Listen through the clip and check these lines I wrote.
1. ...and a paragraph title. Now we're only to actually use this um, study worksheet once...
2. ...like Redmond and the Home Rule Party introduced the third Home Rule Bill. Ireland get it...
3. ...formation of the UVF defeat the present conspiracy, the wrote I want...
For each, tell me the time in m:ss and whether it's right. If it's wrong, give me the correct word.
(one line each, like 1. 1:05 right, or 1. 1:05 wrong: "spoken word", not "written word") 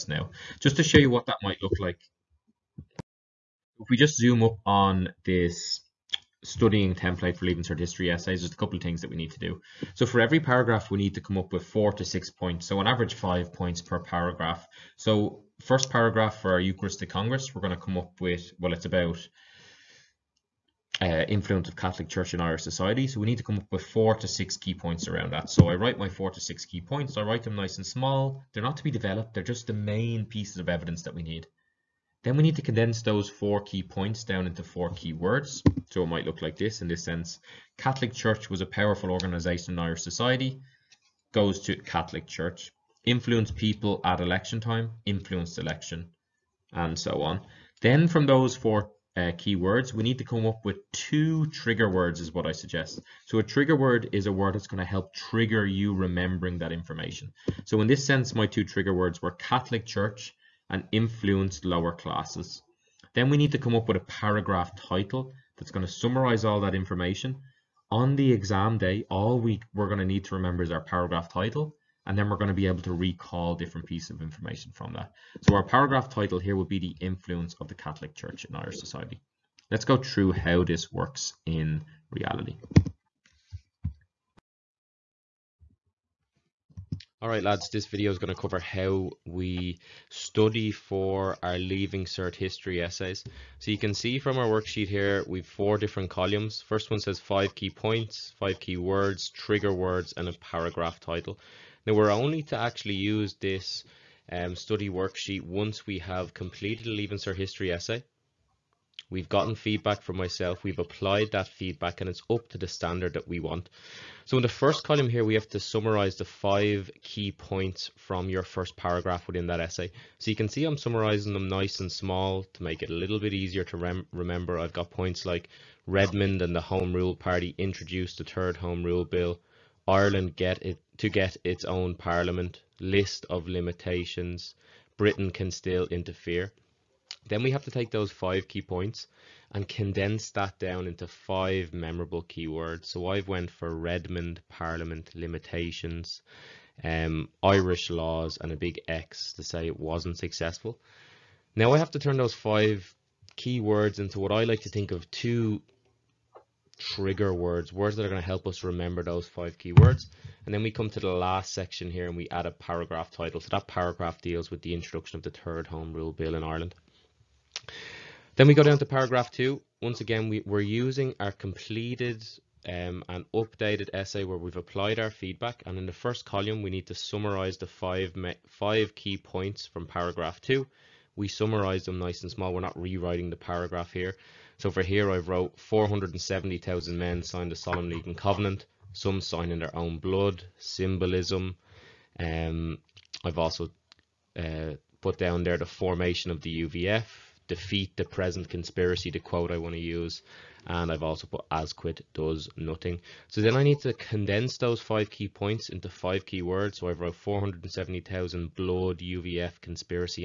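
1. 1:40 right
2. 2:05 right
3. 3:15 wrong: "quote", not "wrote".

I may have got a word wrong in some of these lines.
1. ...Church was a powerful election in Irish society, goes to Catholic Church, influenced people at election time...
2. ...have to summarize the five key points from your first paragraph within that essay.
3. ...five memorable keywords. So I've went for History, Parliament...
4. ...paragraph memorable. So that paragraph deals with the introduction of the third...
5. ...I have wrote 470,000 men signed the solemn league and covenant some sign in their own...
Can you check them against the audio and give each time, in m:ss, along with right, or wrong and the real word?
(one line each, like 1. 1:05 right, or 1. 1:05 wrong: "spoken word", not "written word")
1. 0:38 wrong: "organisation", not "election"
2. 1:55 right
3. 2:21 wrong: "Redmond", not "History"
4. 2:42 wrong: "title", not "memorable"
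5. 3:05 right.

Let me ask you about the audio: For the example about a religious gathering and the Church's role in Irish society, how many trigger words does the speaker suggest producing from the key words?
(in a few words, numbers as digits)
2.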